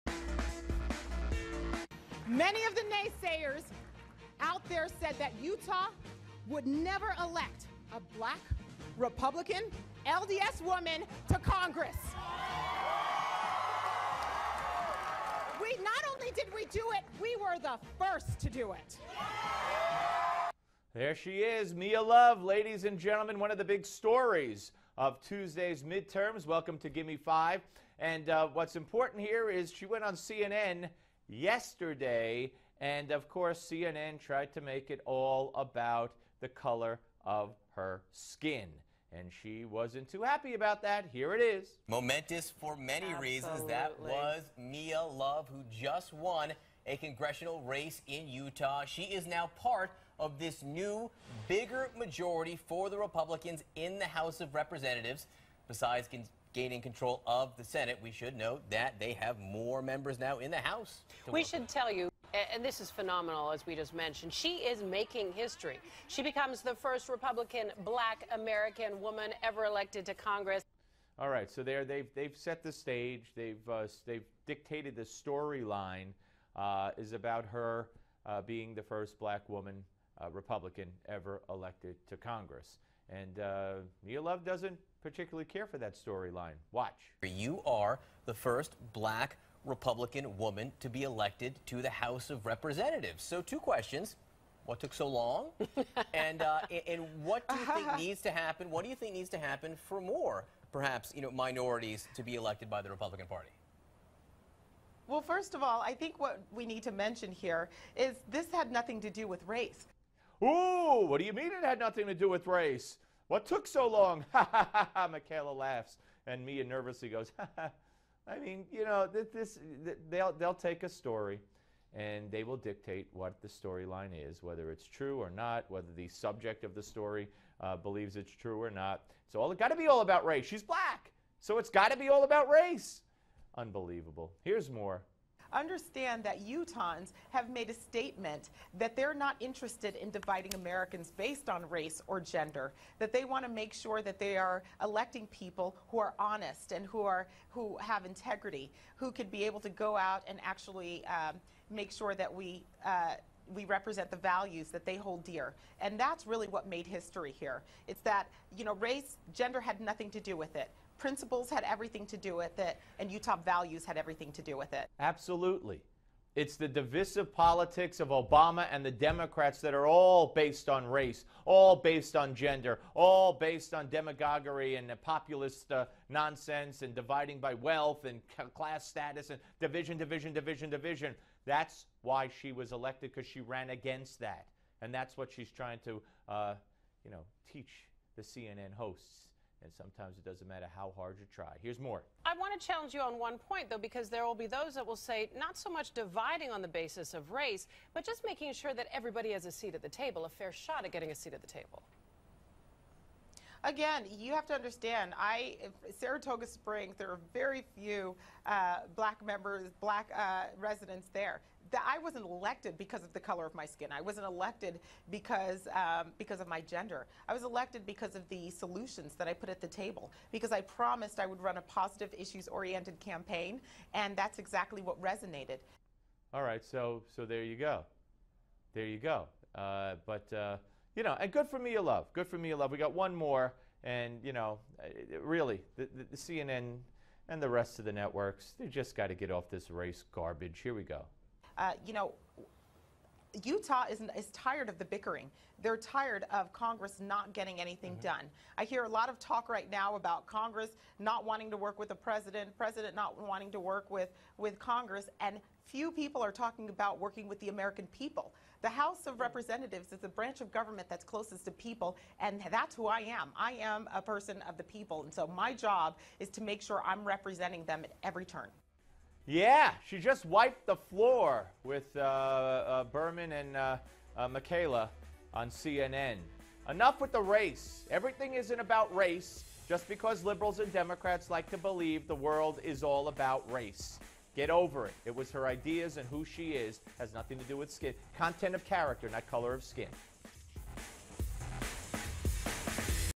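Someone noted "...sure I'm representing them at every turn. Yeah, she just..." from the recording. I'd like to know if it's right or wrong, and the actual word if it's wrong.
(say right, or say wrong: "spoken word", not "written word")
right.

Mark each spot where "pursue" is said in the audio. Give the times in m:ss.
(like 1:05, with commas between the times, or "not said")
not said.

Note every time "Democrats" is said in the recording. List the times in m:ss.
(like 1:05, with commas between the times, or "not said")
2:48, 4:40.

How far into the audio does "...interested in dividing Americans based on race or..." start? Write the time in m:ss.
2:19.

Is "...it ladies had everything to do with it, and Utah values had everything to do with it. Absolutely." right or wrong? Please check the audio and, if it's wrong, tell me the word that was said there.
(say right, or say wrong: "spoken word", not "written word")
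wrong: "principles", not "ladies".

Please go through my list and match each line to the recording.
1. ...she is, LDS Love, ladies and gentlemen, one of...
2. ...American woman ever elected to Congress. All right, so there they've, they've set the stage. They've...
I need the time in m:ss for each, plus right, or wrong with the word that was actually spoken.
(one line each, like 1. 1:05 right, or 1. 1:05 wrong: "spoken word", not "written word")
1. 0:21 wrong: "Mia", not "LDS"
2. 1:08 right.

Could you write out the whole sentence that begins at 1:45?
Well, first of all, I think what we need to mention here is this had nothing to do with race.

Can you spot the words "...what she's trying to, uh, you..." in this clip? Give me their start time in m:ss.
3:05.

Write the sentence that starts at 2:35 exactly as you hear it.
And that's really what made history here.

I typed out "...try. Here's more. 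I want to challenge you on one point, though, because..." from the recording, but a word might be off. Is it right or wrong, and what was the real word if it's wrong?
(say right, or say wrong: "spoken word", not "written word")
right.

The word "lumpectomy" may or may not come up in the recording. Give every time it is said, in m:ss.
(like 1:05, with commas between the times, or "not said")
not said.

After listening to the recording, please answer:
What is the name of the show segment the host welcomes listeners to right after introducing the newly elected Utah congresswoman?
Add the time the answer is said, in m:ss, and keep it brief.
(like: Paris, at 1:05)
Gimme 5, at 0:26.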